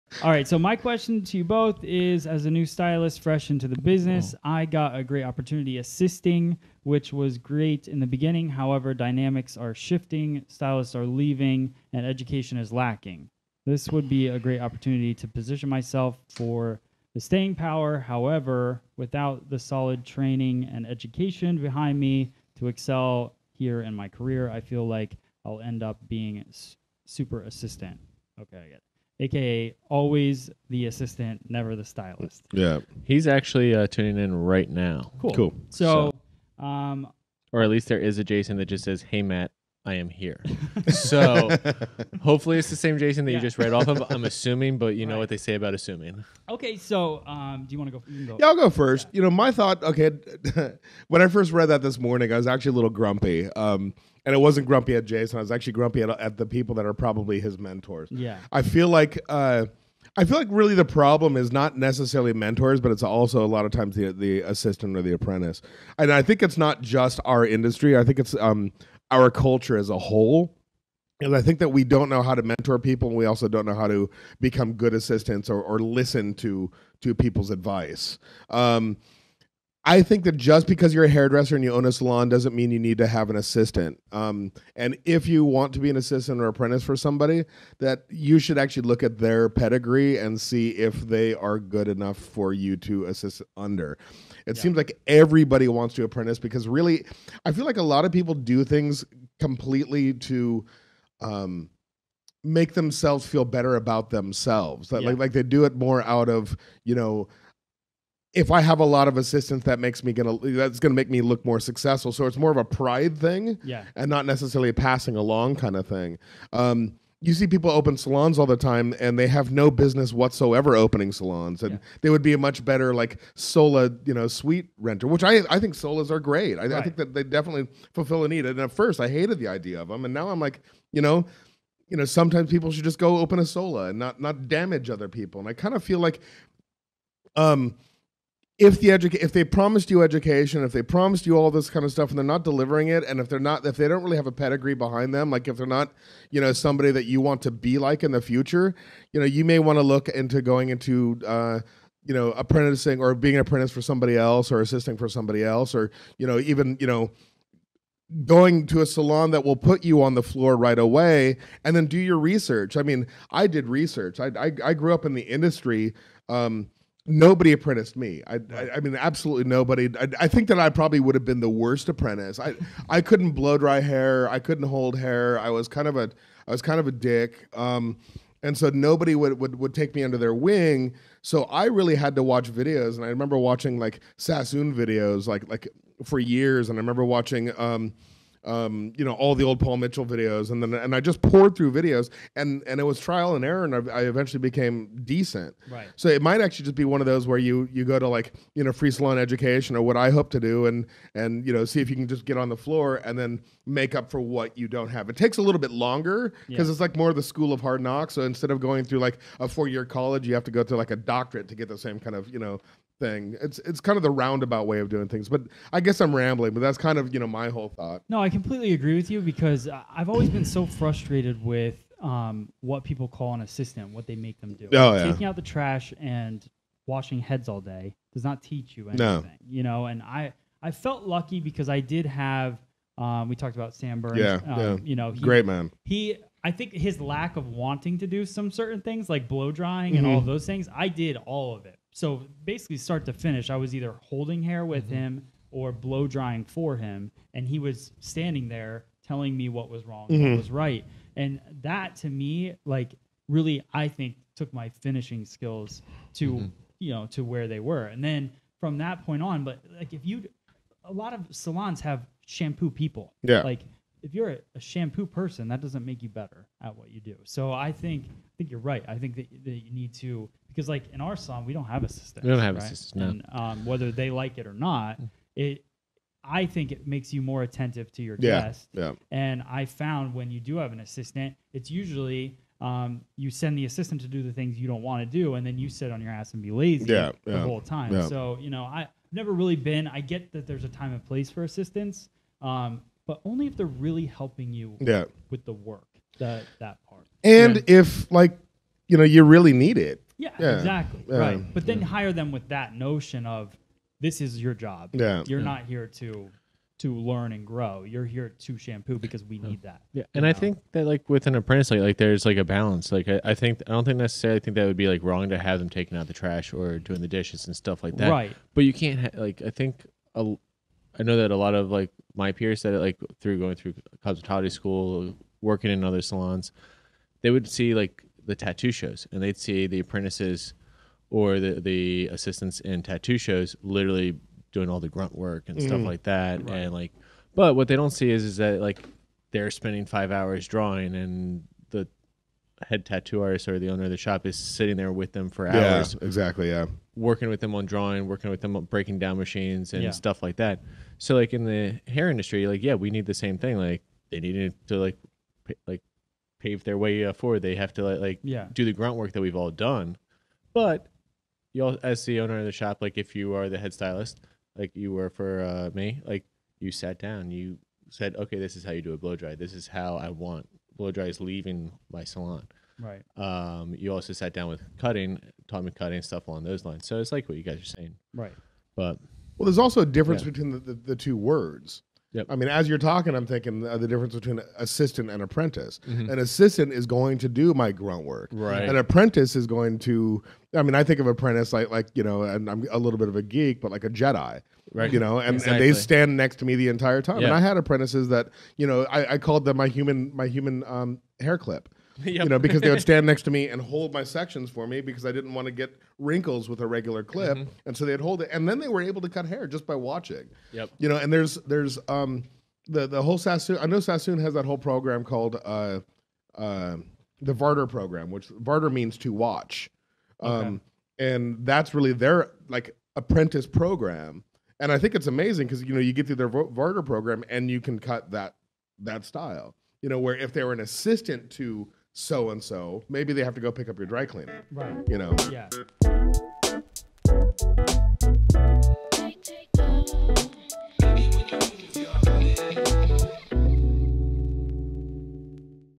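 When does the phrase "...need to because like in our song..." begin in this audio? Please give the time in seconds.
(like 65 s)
269 s.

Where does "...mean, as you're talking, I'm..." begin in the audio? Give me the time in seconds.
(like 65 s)
382 s.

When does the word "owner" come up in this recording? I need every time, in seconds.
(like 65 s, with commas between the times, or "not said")
343 s, 362 s.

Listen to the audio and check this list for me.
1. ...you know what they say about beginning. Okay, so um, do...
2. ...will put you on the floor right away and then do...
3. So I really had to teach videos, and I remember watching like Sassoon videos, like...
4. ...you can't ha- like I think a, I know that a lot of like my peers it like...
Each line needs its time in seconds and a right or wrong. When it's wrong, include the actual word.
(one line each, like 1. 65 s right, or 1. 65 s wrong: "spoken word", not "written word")
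1. 44 s wrong: "assuming", not "beginning"
2. 159 s right
3. 181 s wrong: "watch", not "teach"
4. 318 s right.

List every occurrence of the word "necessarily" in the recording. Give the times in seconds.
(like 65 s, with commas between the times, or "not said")
61 s, 114 s, 313 s.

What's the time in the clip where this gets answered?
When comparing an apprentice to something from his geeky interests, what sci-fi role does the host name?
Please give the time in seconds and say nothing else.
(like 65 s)
393 s.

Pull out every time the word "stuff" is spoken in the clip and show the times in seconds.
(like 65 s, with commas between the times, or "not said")
141 s, 317 s, 335 s, 349 s, 376 s.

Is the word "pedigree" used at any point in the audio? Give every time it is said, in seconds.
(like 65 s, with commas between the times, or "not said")
89 s, 144 s.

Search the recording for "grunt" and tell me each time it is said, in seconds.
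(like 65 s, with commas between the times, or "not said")
334 s, 358 s, 387 s.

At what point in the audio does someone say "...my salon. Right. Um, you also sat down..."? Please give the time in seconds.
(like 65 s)
371 s.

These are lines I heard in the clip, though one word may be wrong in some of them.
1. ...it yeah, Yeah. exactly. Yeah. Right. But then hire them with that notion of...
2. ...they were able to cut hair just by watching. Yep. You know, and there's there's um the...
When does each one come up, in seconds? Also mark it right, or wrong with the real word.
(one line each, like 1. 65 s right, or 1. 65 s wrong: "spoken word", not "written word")
1. 299 s right
2. 408 s right.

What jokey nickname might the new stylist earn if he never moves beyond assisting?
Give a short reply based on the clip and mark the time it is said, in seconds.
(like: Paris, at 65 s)
super assistant, at 27 s.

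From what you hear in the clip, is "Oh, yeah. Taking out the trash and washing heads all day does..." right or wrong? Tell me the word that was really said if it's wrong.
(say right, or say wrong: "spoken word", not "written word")
right.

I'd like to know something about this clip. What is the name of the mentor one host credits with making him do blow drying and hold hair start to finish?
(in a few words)
Sam Burns.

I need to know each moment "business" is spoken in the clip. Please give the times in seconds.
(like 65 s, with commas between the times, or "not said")
3 s, 119 s.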